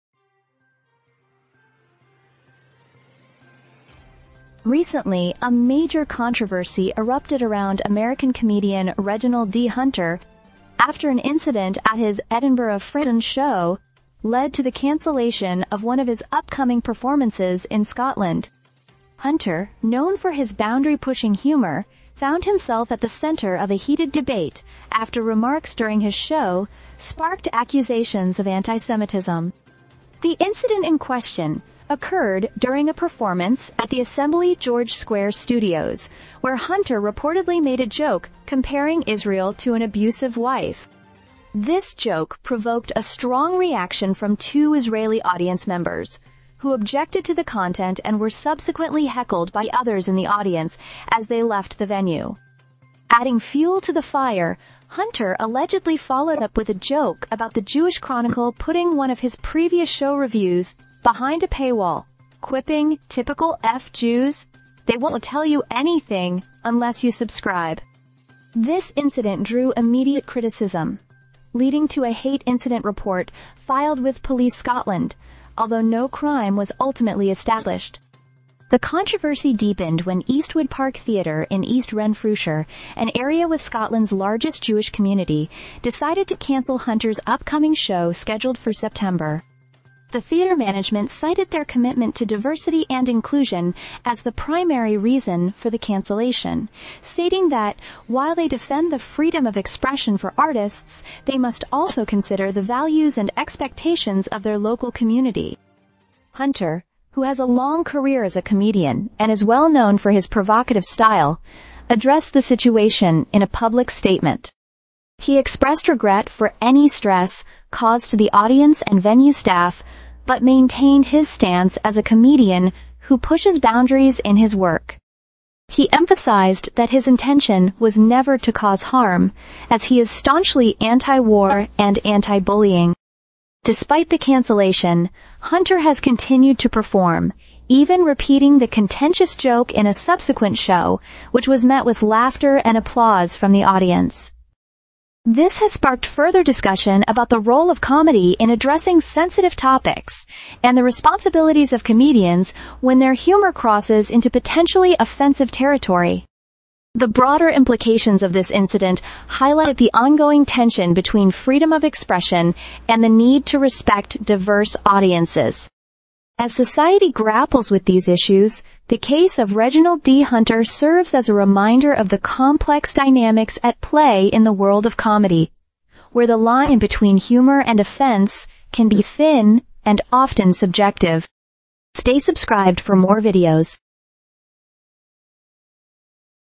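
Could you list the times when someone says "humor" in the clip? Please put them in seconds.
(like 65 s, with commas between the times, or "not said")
21 s, 153 s, 177 s.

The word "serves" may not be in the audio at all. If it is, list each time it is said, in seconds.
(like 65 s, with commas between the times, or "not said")
170 s.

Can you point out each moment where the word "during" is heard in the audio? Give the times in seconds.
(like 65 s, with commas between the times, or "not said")
25 s, 32 s.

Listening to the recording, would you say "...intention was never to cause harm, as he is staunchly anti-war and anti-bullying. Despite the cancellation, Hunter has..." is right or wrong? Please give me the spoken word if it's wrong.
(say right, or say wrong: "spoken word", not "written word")
right.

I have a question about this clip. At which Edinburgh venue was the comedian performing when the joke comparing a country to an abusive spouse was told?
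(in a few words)
Assembly George Square Studios.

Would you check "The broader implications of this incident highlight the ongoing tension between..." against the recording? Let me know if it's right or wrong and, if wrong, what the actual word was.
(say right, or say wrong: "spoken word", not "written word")
right.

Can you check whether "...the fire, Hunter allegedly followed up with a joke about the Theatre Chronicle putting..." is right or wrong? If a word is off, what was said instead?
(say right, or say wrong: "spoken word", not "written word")
wrong: "Jewish", not "Theatre".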